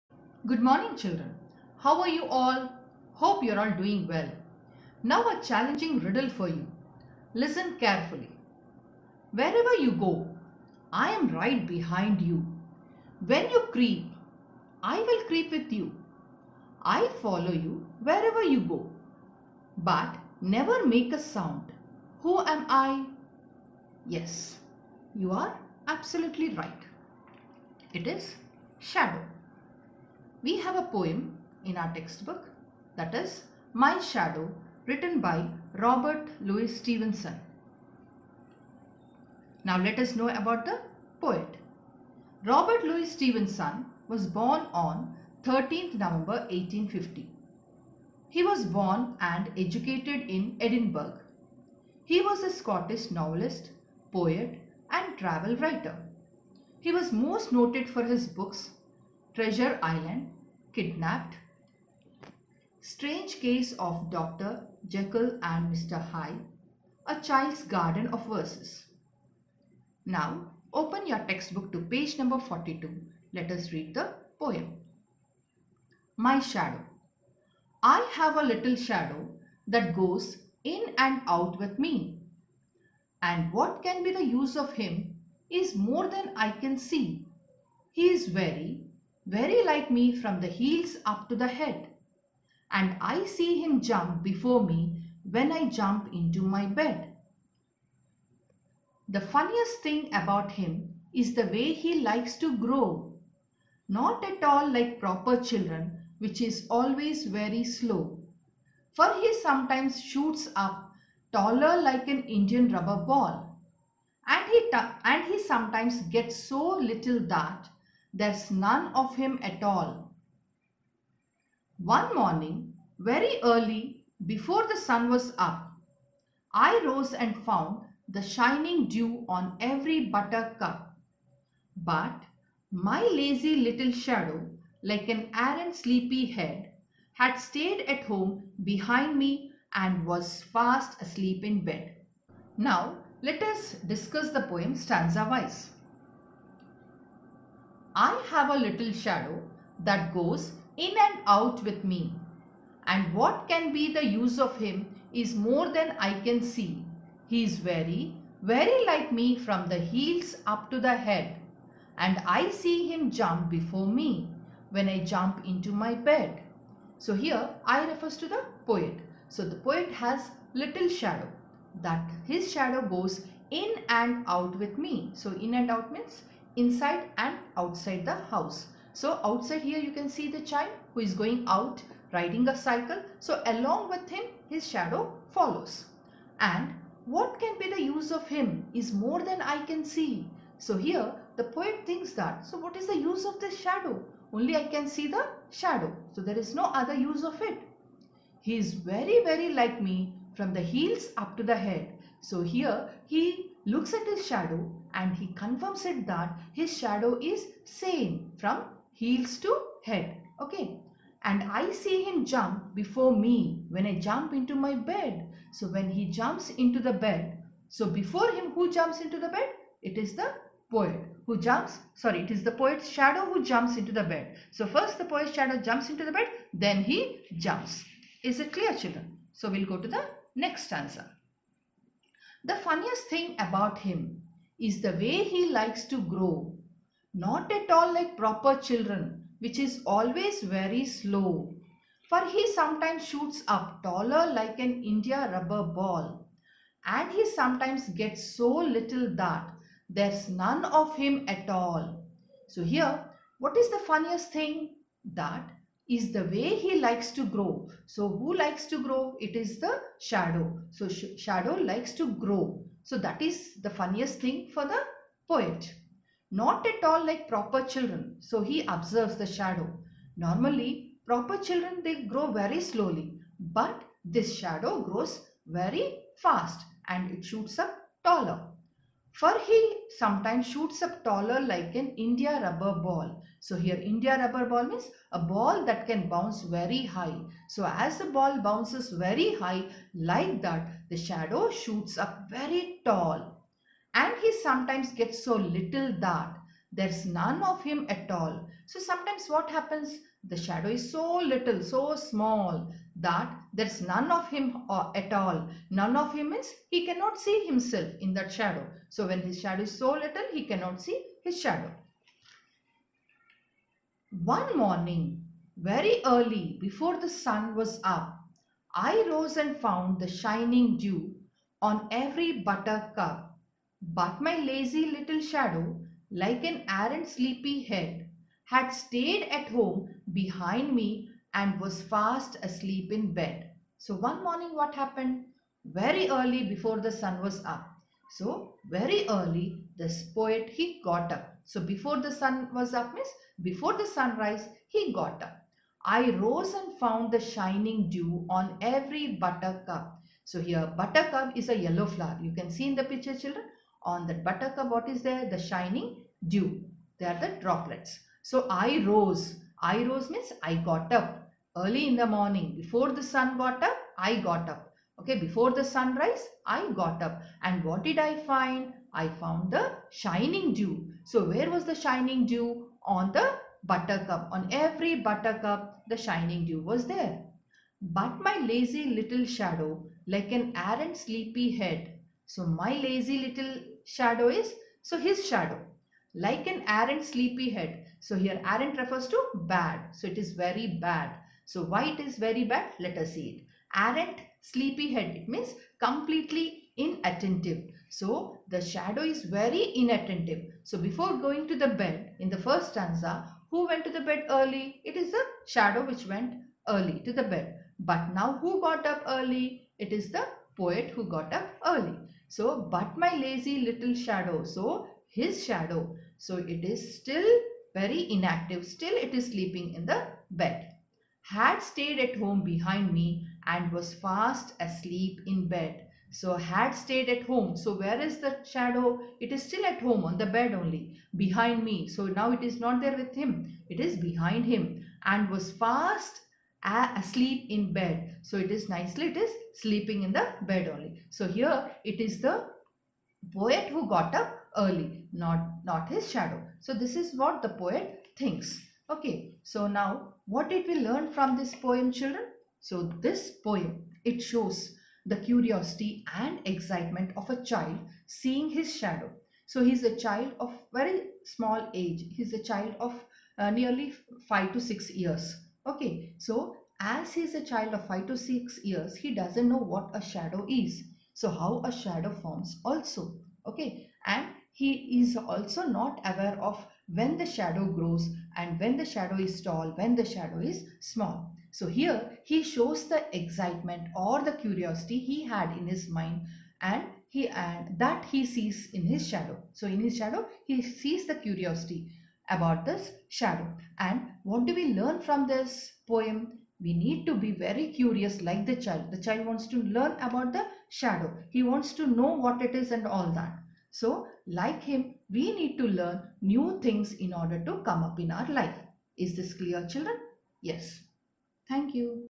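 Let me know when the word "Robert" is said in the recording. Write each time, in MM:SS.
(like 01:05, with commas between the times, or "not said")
00:35, 00:42.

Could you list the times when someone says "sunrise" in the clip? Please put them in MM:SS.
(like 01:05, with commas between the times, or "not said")
05:43, 06:05.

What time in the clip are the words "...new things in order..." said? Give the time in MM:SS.
08:26.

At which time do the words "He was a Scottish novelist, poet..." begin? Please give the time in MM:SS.
00:52.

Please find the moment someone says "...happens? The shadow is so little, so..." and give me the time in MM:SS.
04:59.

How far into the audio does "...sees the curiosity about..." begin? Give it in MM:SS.
08:10.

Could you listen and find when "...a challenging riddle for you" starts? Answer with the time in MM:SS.
00:05.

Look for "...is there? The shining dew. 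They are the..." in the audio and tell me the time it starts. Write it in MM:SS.
05:54.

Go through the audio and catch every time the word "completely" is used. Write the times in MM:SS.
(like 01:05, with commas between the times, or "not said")
06:35.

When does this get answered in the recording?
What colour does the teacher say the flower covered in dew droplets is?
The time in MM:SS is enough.
05:51.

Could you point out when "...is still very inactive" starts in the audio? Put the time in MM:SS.
06:56.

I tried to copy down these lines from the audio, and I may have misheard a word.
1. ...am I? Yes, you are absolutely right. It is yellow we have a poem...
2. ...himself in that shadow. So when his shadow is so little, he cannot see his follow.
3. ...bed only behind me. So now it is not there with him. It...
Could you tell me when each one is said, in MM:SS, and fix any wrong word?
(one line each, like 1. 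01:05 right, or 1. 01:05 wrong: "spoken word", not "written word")
1. 00:22 wrong: "shadow", not "yellow"
2. 05:07 wrong: "shadow", not "follow"
3. 07:10 right.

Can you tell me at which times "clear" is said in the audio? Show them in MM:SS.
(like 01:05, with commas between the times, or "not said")
03:48, 08:29.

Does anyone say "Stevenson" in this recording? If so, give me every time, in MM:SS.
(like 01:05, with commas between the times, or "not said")
00:36, 00:43.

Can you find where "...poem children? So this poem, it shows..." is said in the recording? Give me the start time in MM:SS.
07:31.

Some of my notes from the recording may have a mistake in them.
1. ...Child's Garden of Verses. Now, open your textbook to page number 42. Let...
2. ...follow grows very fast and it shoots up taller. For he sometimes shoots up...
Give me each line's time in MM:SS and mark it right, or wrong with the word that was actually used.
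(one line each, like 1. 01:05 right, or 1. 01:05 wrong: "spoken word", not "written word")
1. 01:07 right
2. 04:34 wrong: "shadow", not "follow".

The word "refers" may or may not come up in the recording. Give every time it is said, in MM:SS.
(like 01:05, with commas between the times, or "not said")
02:47, 06:28.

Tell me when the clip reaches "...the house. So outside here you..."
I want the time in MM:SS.
02:58.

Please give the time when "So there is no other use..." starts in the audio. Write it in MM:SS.
03:16.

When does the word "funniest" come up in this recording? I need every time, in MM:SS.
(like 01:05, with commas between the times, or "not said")
01:39, 03:52, 04:13, 04:23.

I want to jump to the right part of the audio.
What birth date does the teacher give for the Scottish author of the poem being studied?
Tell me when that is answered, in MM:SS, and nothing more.
00:45.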